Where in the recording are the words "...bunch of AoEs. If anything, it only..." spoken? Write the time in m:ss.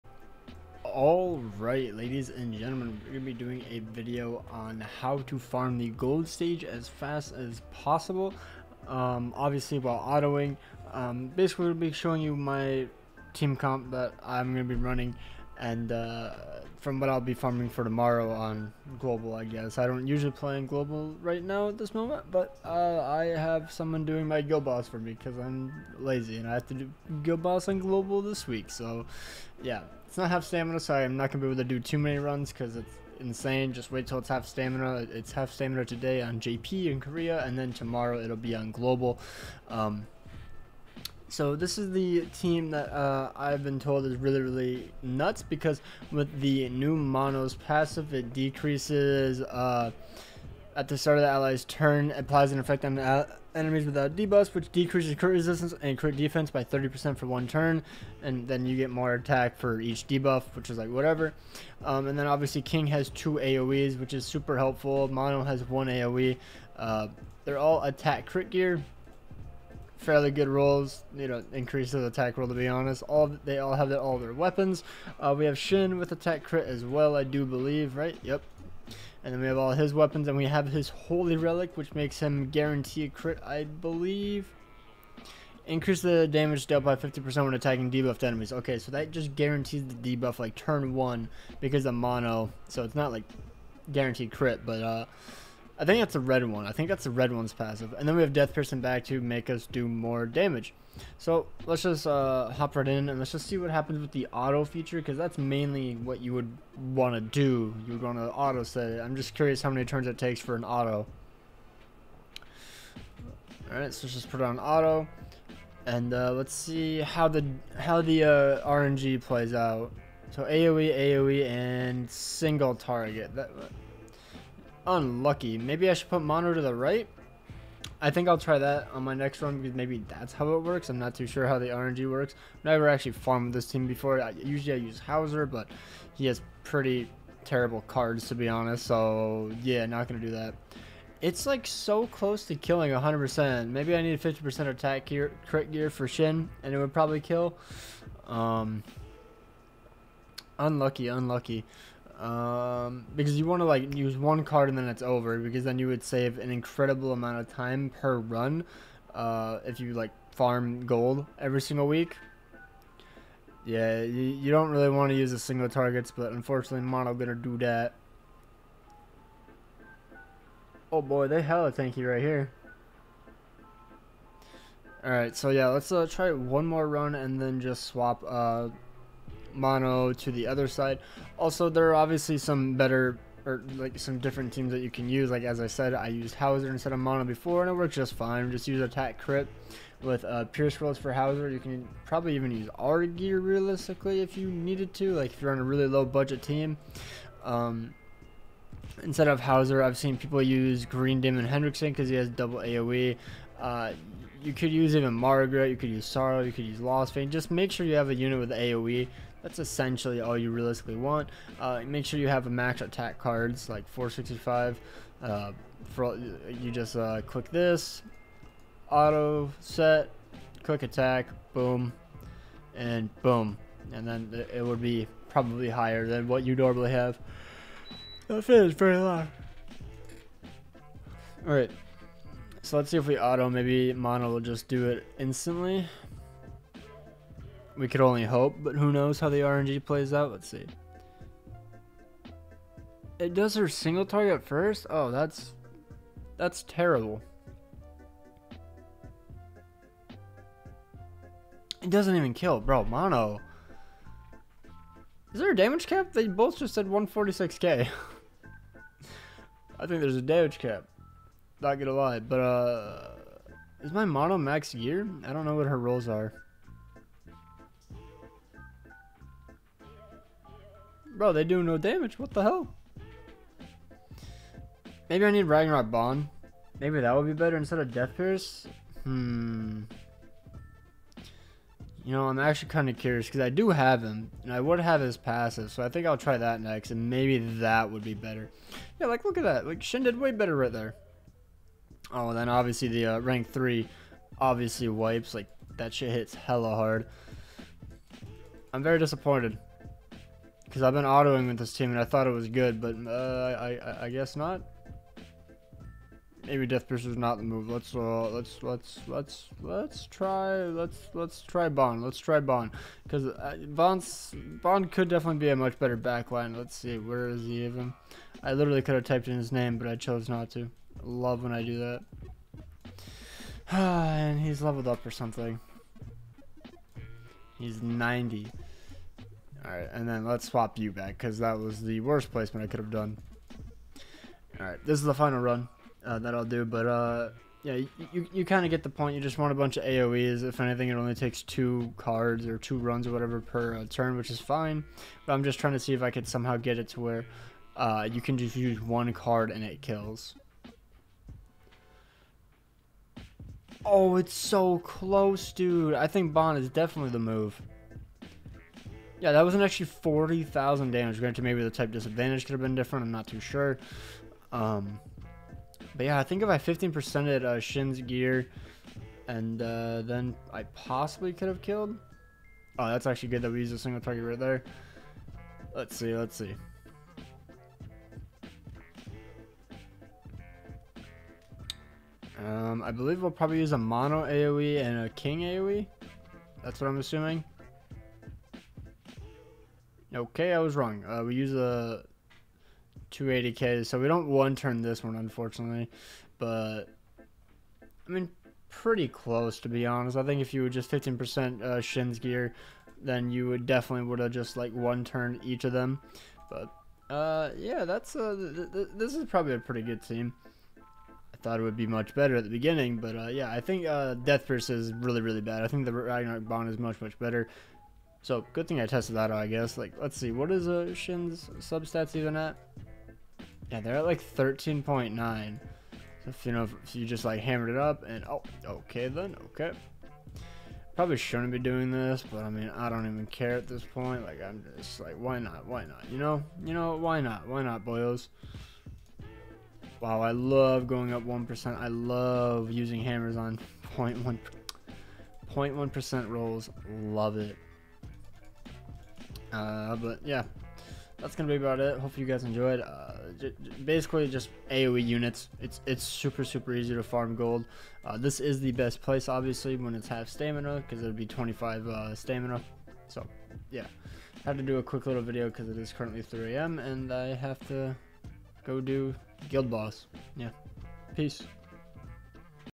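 5:39.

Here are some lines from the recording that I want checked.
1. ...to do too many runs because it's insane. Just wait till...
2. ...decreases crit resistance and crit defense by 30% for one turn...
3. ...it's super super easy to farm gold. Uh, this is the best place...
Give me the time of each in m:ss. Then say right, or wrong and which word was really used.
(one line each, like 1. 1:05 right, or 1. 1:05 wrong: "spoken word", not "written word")
1. 0:31 right
2. 0:54 right
3. 7:35 right.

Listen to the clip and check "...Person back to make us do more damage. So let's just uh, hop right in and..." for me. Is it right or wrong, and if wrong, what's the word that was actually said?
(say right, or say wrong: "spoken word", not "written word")
right.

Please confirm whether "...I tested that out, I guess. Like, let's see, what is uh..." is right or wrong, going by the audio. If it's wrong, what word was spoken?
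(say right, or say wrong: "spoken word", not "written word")
right.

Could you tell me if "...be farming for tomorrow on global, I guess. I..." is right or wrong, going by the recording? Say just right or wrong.
right.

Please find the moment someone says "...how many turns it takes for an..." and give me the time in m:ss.
1:49.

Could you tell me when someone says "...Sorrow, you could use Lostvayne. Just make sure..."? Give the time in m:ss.
3:26.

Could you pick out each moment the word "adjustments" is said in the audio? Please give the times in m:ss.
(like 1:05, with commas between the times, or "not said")
not said.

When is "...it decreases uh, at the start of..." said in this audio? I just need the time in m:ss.
0:48.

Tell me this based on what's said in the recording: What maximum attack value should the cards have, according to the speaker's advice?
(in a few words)
465.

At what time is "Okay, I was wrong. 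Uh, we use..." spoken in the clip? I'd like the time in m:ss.
6:30.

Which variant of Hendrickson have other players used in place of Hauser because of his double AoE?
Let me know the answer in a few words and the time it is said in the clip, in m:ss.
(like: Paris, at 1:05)
Green Demon Hendrickson, at 3:20.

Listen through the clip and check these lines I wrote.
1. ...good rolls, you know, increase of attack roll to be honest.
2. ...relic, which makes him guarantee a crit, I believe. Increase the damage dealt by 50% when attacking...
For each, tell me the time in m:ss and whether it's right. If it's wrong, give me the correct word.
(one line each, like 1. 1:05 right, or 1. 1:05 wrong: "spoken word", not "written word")
1. 1:10 right
2. 1:21 right.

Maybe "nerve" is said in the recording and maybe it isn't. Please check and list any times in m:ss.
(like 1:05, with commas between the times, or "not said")
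not said.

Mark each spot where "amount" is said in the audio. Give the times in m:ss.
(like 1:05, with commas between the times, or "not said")
2:37.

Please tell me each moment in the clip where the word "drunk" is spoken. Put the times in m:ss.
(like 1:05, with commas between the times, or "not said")
not said.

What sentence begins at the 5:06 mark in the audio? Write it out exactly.
Maybe Death Piercer is not the move.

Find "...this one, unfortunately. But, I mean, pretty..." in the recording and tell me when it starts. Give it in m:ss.
6:34.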